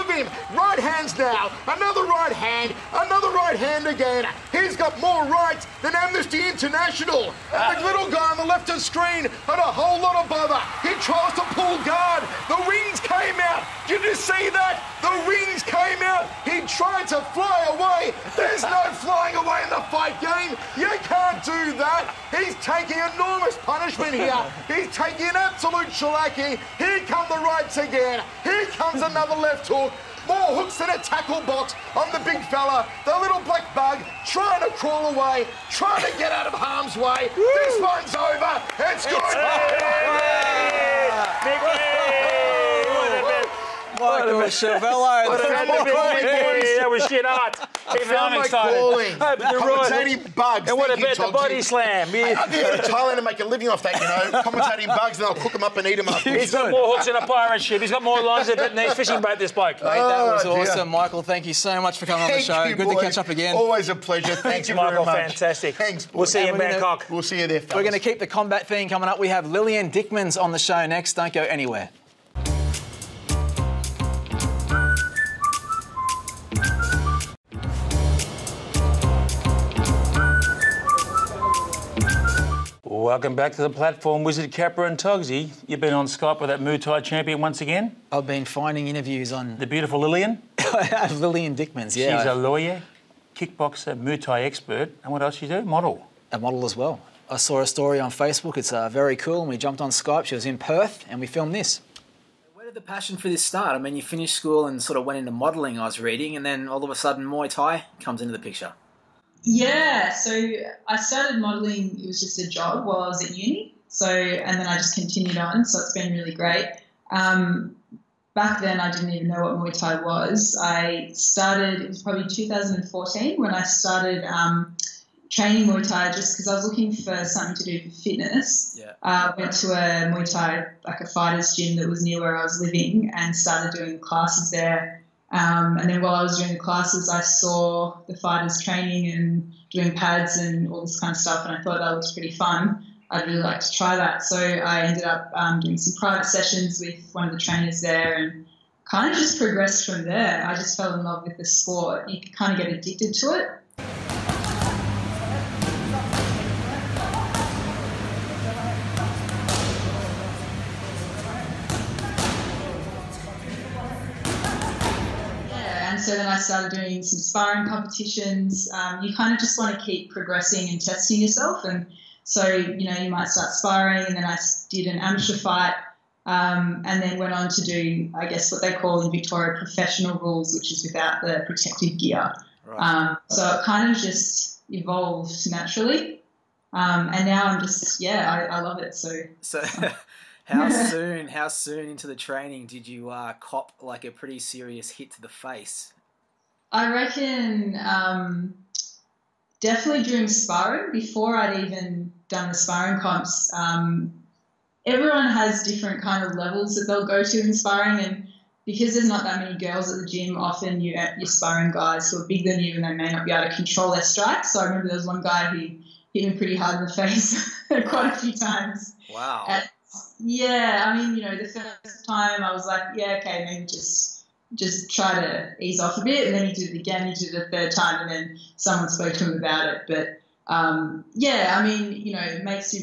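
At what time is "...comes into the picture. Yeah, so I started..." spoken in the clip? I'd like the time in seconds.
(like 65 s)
107 s.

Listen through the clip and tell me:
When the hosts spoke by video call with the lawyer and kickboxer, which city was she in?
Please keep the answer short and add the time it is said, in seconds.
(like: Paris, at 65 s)
Perth, at 100 s.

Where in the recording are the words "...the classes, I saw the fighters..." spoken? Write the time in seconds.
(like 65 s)
136 s.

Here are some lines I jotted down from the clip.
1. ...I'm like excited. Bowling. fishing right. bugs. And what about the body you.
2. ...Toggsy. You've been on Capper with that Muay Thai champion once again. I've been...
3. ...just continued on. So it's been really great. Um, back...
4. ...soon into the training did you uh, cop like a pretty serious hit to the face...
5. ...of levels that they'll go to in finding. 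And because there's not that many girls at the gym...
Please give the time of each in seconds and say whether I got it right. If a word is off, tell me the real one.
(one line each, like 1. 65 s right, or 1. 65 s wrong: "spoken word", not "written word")
1. 48 s wrong: "commentating", not "fishing"
2. 84 s wrong: "Skype", not "Capper"
3. 114 s right
4. 191 s right
5. 206 s wrong: "sparring", not "finding".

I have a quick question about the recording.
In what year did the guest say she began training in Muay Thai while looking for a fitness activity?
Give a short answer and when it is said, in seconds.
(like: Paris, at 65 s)
2014, at 122 s.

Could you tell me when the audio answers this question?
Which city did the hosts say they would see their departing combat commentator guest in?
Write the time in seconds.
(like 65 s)
66 s.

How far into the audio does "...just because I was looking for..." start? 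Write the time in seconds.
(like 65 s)
126 s.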